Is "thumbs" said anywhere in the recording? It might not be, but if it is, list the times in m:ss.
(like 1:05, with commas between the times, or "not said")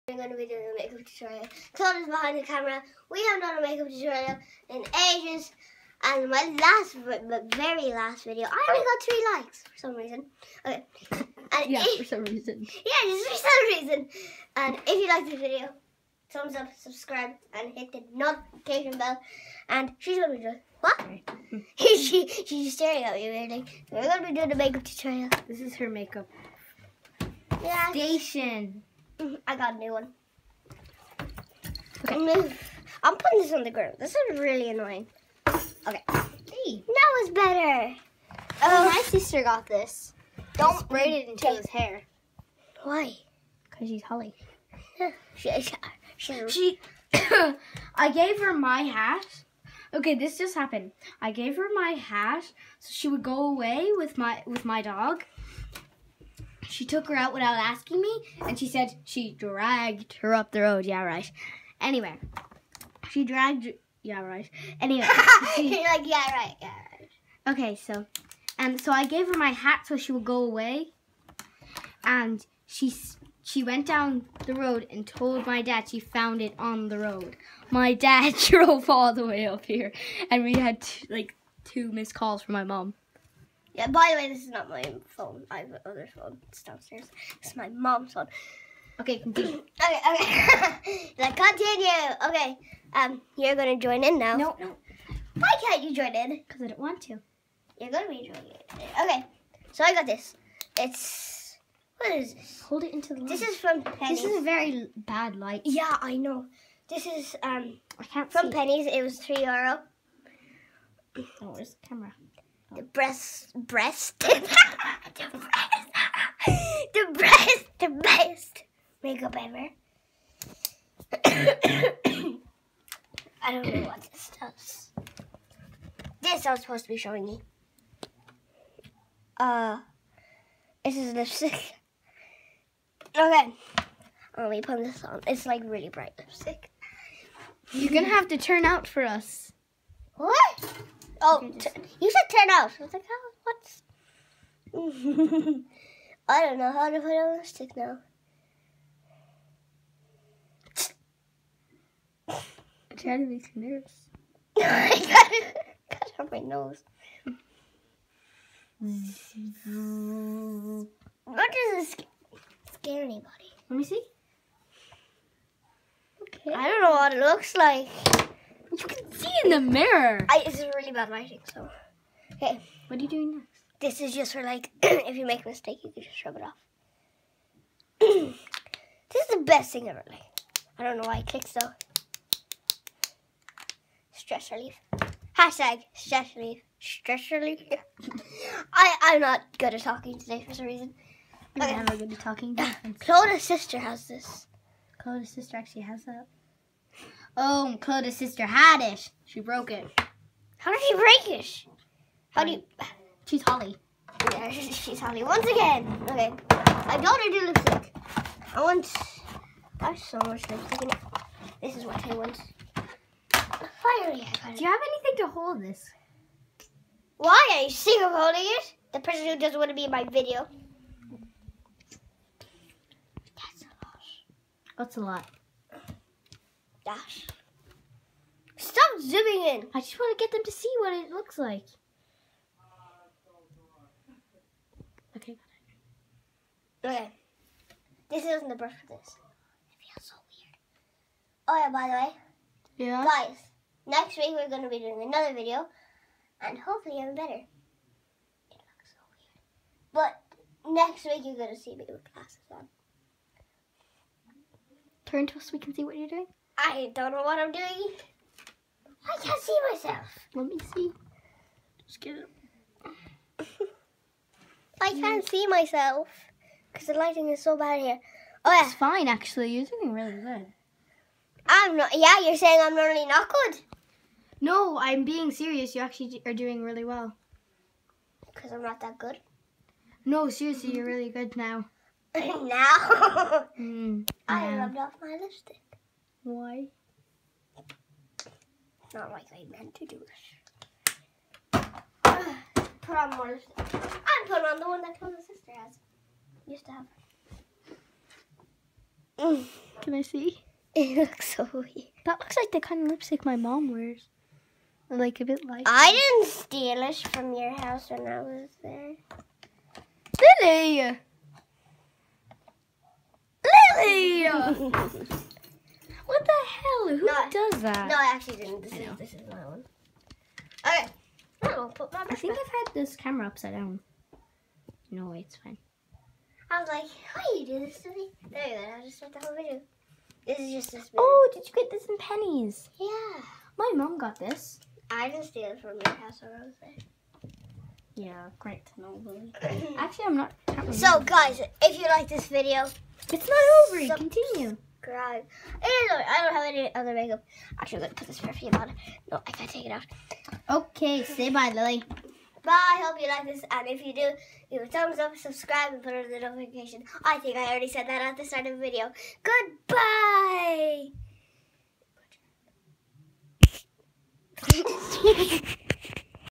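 0:16, 5:54.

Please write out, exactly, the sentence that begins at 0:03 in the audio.
We have done a makeup tutorial in ages.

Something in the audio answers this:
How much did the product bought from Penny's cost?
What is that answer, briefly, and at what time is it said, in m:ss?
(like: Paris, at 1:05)
3 euro, at 1:49.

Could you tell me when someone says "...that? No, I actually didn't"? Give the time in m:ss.
5:17.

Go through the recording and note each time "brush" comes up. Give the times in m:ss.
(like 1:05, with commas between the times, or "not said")
3:58.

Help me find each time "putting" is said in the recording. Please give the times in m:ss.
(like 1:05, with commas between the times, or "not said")
0:33, 4:54.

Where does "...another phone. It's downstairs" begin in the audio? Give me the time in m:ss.
1:25.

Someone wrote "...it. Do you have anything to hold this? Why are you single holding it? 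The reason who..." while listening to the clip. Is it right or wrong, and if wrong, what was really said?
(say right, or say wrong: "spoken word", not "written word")
wrong: "person", not "reason".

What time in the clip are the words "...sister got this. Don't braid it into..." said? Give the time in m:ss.
0:39.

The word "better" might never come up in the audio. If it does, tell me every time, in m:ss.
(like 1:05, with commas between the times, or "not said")
0:37, 4:07.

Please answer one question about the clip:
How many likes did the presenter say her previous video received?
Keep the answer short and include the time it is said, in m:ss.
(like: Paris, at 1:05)
3, at 0:09.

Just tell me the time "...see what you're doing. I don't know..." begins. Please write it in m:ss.
4:15.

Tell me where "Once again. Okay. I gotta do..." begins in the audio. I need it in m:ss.
3:25.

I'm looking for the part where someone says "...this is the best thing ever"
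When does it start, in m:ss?
2:57.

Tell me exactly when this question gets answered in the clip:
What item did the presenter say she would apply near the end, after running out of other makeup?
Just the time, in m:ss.
5:48.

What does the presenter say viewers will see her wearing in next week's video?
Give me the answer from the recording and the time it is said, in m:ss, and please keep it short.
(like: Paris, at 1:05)
Glasses, at 4:12.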